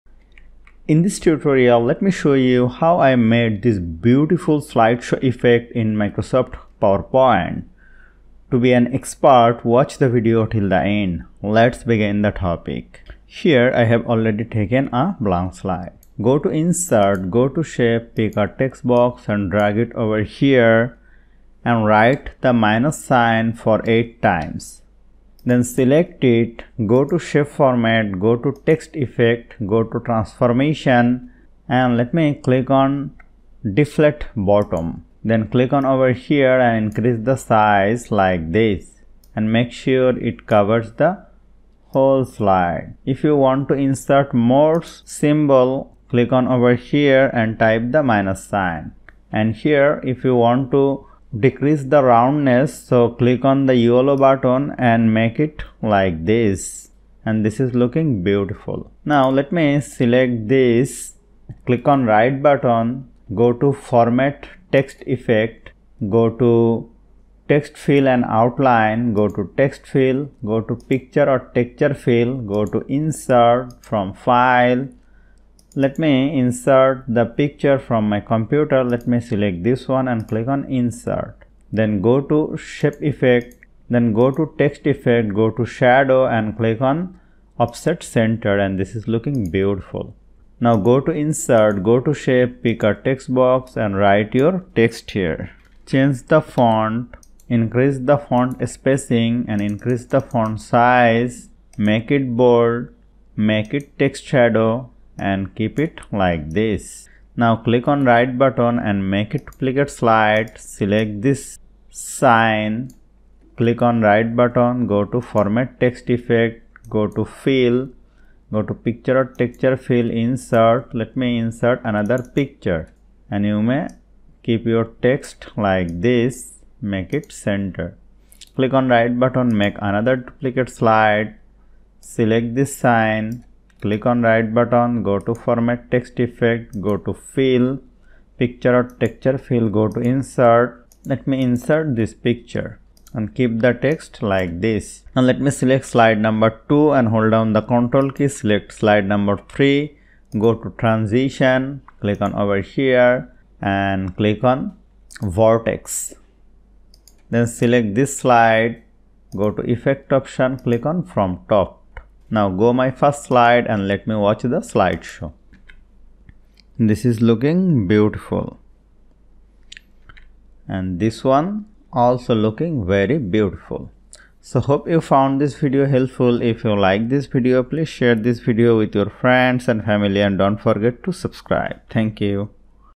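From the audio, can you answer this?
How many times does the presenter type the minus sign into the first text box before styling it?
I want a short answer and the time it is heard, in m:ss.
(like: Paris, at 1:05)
8, at 0:23.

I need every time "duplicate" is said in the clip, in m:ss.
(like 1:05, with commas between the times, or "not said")
1:49, 2:10.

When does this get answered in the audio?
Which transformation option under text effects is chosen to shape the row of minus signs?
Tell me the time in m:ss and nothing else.
0:33.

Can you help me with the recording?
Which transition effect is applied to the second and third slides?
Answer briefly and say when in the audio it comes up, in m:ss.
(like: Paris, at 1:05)
Vortex, at 2:35.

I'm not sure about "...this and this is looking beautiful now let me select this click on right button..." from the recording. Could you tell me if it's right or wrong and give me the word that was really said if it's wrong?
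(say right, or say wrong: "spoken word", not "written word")
right.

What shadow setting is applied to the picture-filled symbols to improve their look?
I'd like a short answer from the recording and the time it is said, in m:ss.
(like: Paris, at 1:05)
Offset center, at 1:27.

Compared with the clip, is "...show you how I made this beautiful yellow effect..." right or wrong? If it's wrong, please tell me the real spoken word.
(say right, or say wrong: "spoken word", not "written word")
wrong: "slideshow", not "yellow".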